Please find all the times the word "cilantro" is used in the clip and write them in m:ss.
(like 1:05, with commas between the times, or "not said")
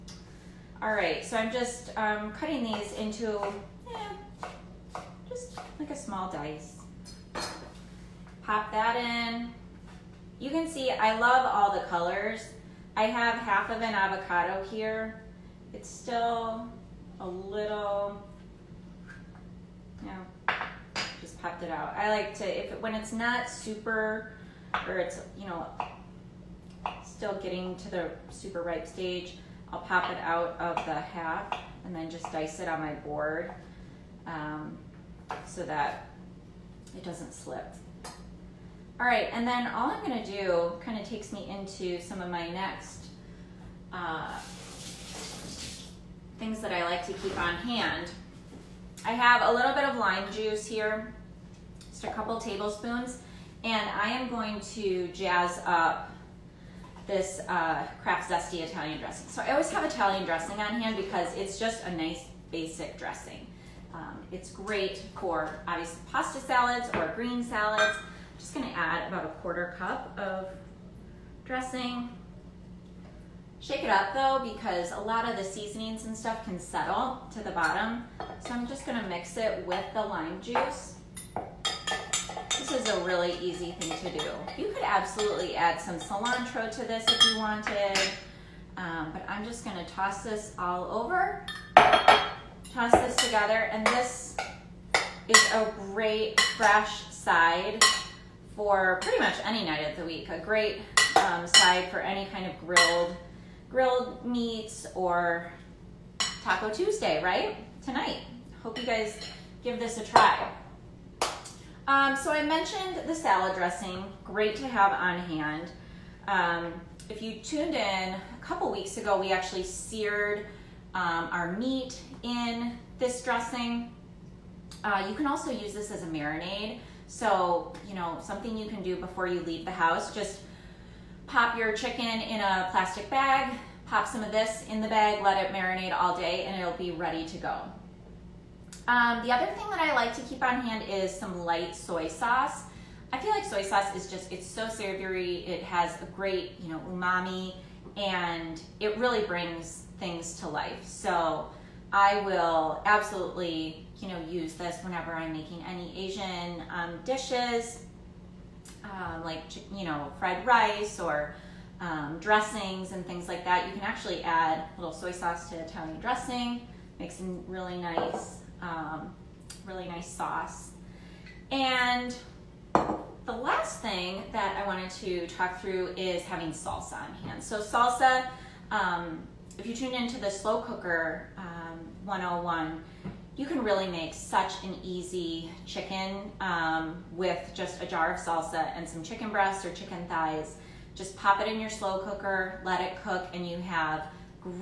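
1:25.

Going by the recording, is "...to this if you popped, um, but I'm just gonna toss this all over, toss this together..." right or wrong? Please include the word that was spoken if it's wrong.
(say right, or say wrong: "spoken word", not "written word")
wrong: "wanted", not "popped".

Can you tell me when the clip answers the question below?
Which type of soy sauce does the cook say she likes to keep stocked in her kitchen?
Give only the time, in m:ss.
2:21.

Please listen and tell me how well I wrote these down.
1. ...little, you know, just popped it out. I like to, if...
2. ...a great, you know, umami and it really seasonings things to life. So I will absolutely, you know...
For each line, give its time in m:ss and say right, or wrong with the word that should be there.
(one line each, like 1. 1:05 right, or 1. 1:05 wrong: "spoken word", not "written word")
1. 0:17 right
2. 2:26 wrong: "brings", not "seasonings".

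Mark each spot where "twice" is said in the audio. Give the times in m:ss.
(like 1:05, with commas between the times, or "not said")
not said.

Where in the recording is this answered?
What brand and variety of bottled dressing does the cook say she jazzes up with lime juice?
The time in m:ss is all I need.
0:58.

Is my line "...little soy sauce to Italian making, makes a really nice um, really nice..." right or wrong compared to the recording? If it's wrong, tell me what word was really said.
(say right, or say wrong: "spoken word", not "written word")
wrong: "dressing", not "making".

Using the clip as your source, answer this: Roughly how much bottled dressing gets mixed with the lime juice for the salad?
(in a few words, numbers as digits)
a quarter cup.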